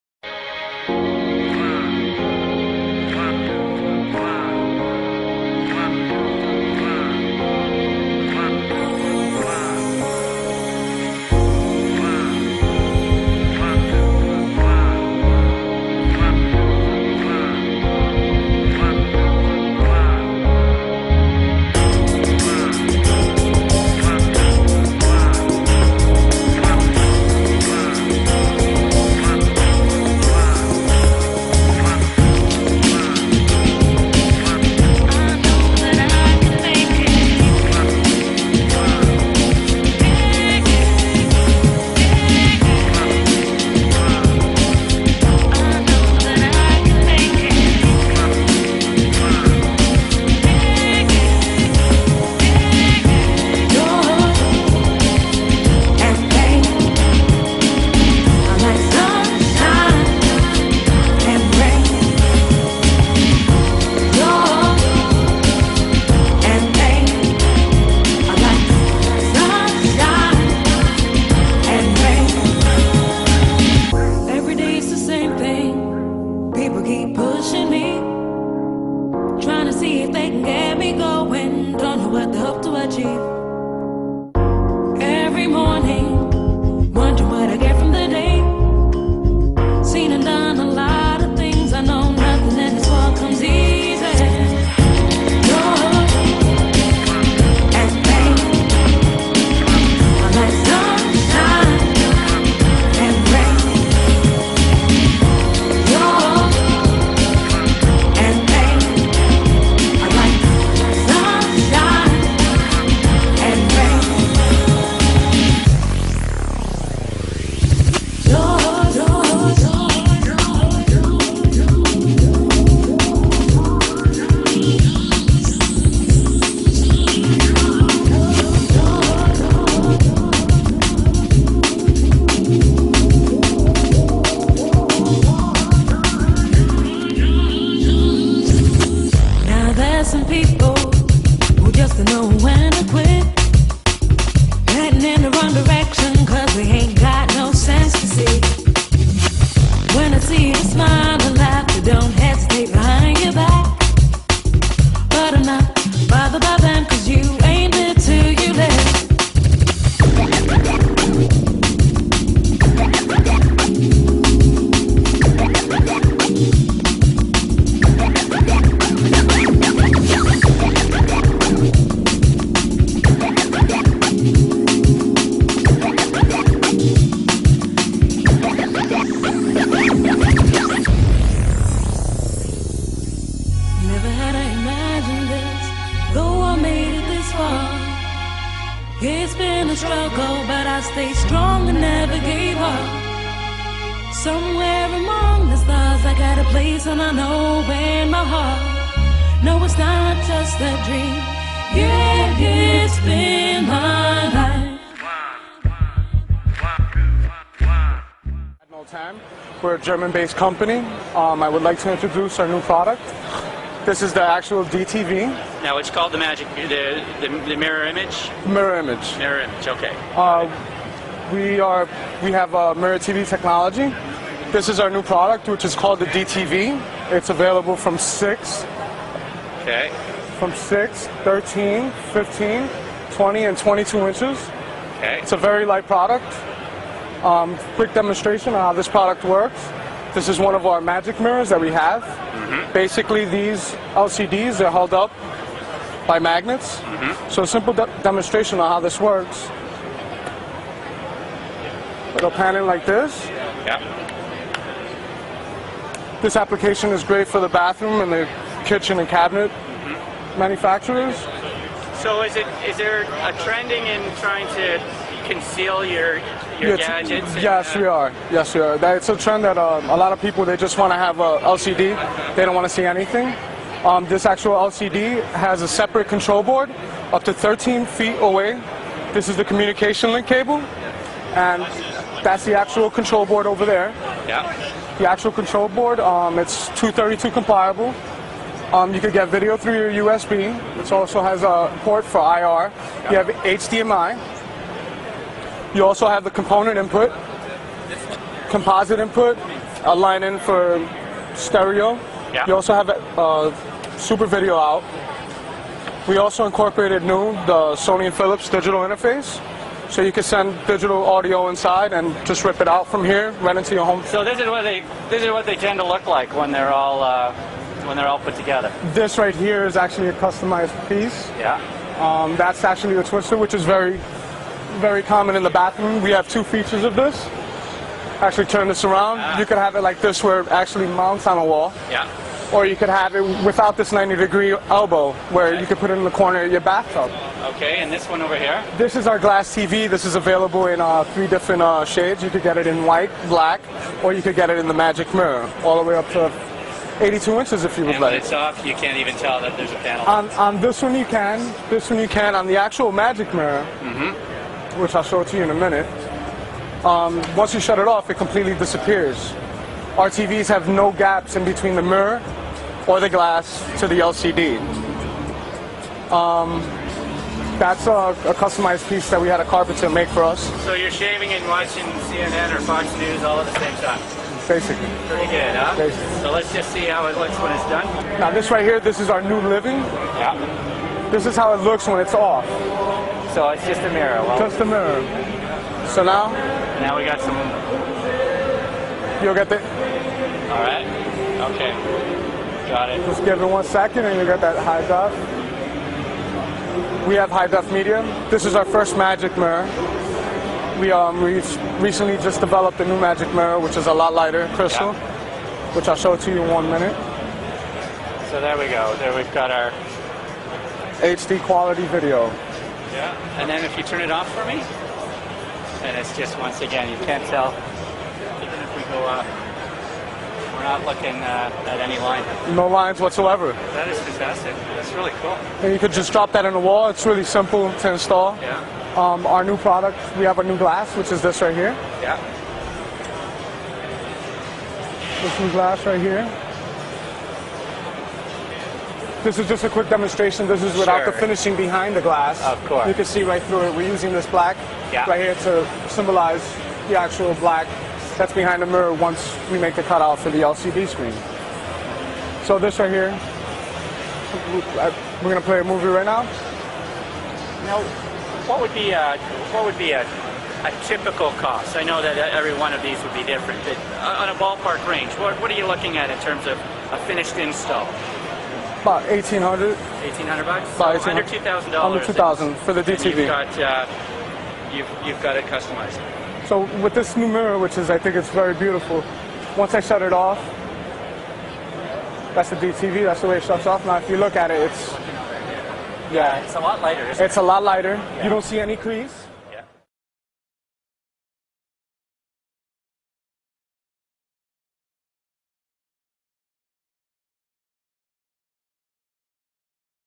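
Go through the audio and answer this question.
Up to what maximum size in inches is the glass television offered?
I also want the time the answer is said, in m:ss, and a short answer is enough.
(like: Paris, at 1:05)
82 inches, at 5:47.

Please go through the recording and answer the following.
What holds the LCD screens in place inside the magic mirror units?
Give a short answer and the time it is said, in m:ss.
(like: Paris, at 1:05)
Magnets, at 4:06.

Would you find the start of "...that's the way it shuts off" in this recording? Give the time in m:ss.
8:03.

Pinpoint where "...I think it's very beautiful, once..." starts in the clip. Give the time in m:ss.
7:57.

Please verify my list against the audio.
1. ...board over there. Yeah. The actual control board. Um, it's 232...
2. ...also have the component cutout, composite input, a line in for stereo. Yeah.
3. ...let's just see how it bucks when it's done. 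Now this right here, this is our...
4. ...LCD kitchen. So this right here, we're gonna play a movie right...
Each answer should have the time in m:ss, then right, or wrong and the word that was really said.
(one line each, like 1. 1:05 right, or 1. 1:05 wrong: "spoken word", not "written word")
1. 4:43 right
2. 4:55 wrong: "input", not "cutout"
3. 6:16 wrong: "looks", not "bucks"
4. 7:30 wrong: "screen", not "kitchen".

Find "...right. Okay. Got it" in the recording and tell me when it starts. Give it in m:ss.
6:30.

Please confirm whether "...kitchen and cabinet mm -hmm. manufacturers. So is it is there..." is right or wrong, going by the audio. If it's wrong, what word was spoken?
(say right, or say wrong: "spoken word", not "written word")
right.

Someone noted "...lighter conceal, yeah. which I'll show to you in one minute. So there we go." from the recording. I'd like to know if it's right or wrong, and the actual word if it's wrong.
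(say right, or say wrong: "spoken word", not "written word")
wrong: "crystal", not "conceal".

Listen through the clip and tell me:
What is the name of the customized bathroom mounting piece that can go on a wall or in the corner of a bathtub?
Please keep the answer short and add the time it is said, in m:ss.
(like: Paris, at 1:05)
twister, at 5:23.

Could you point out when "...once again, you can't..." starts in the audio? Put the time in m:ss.
6:56.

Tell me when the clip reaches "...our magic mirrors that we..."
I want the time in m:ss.
4:00.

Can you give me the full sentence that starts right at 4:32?
They don't want to see anything.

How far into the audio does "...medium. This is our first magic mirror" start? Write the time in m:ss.
6:37.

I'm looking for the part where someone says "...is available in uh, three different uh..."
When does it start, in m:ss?
5:40.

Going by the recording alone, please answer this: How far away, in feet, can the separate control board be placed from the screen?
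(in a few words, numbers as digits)
13 feet.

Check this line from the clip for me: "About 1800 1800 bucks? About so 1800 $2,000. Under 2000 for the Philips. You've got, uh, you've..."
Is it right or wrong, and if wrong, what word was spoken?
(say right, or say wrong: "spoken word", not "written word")
wrong: "DTV", not "Philips".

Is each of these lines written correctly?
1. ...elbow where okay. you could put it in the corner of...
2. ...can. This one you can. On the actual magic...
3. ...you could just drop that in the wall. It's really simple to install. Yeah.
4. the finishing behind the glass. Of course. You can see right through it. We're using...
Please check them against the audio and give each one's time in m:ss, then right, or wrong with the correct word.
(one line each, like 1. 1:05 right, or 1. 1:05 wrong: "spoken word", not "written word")
1. 5:34 right
2. 5:51 right
3. 7:05 right
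4. 7:21 right.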